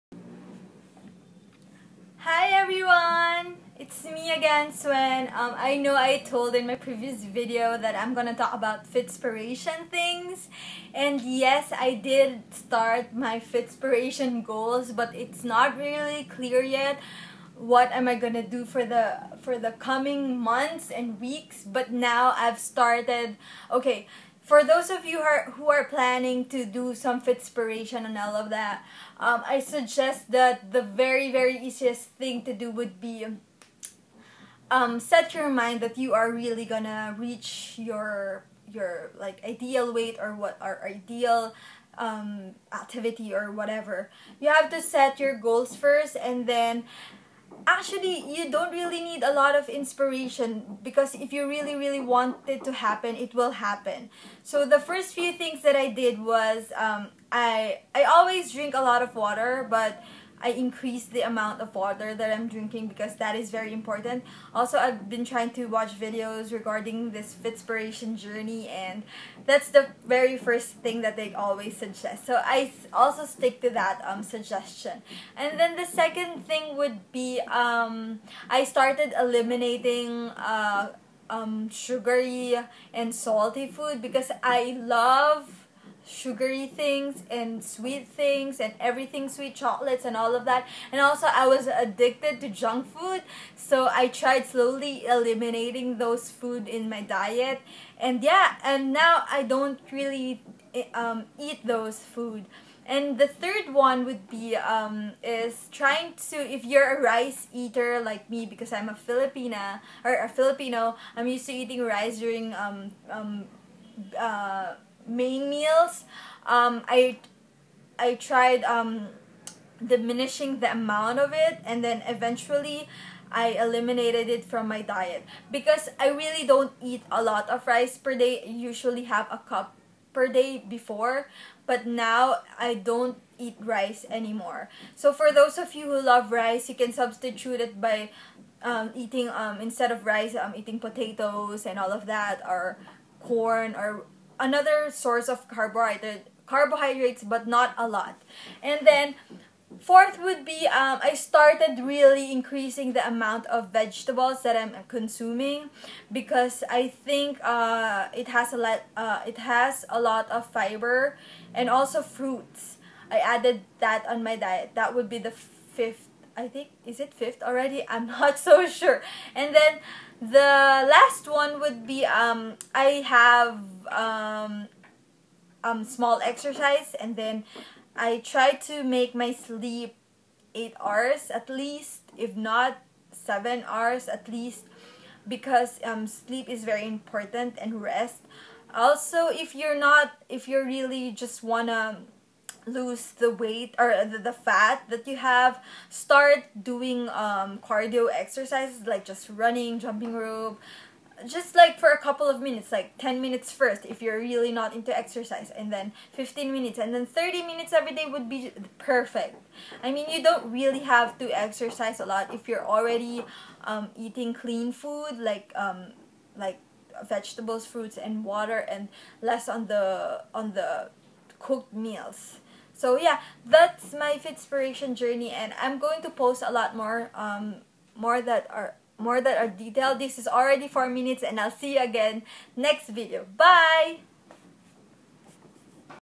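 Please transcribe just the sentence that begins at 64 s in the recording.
Also, I've been trying to watch videos regarding this Fitspiration journey and that's the very first thing that they always suggest.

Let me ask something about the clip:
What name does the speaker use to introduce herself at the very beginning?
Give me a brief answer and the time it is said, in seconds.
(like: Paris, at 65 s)
Swen, at 4 s.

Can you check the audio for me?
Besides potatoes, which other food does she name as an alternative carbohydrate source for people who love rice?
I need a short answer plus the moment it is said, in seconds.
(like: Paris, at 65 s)
corn, at 143 s.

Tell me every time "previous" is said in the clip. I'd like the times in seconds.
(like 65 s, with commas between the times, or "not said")
6 s.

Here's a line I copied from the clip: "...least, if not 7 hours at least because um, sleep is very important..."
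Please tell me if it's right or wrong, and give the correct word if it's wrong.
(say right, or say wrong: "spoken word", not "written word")
right.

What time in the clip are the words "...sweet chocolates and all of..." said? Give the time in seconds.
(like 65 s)
89 s.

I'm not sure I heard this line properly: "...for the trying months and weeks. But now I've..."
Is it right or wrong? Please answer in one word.
wrong.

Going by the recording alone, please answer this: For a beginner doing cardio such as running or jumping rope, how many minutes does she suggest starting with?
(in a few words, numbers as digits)
10 minutes.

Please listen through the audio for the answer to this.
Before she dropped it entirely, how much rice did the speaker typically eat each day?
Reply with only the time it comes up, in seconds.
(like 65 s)
129 s.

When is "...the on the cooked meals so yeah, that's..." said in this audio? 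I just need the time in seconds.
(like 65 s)
219 s.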